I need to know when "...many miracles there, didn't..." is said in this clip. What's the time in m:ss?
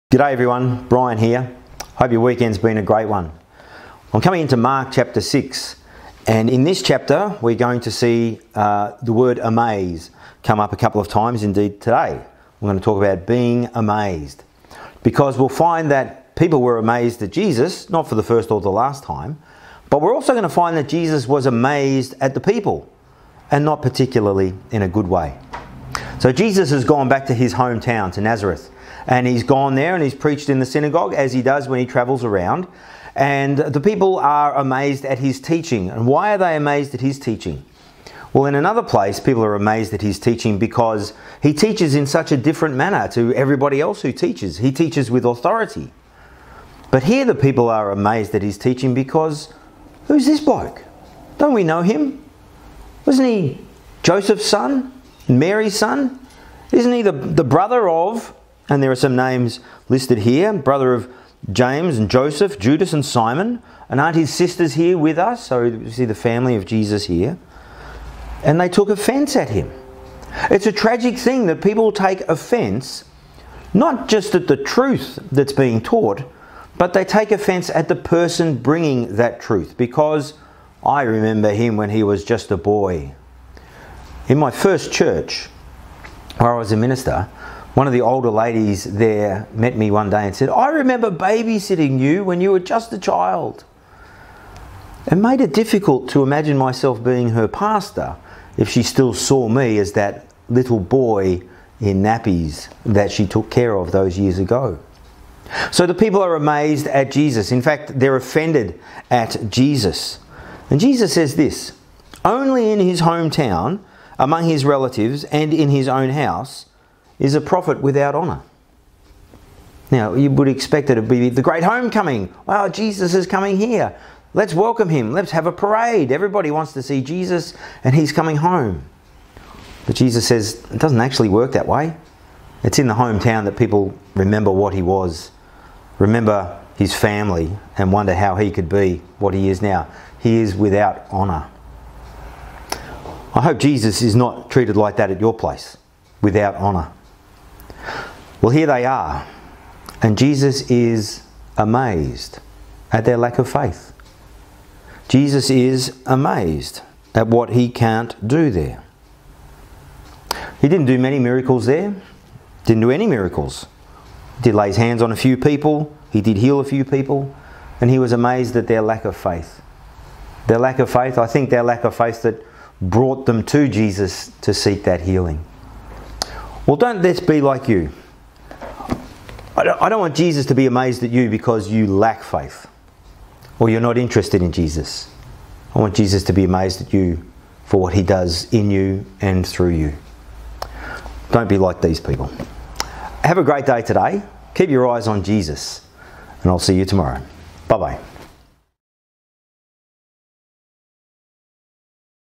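2:40.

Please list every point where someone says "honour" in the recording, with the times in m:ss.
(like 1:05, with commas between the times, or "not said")
1:58, 2:21, 2:26.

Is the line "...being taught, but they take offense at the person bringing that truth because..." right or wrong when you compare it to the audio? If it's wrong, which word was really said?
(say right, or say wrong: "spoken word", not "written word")
right.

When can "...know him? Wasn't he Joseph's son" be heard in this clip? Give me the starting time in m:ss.
0:51.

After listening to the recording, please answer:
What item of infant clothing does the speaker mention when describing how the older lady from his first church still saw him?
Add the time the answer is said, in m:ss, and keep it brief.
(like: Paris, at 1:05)
Nappies, at 1:42.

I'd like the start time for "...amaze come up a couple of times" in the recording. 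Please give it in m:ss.
0:09.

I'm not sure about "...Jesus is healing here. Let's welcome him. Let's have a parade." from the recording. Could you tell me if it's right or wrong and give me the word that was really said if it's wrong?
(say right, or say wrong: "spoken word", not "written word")
wrong: "coming", not "healing".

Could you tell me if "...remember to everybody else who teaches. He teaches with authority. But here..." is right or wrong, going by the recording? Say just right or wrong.
wrong.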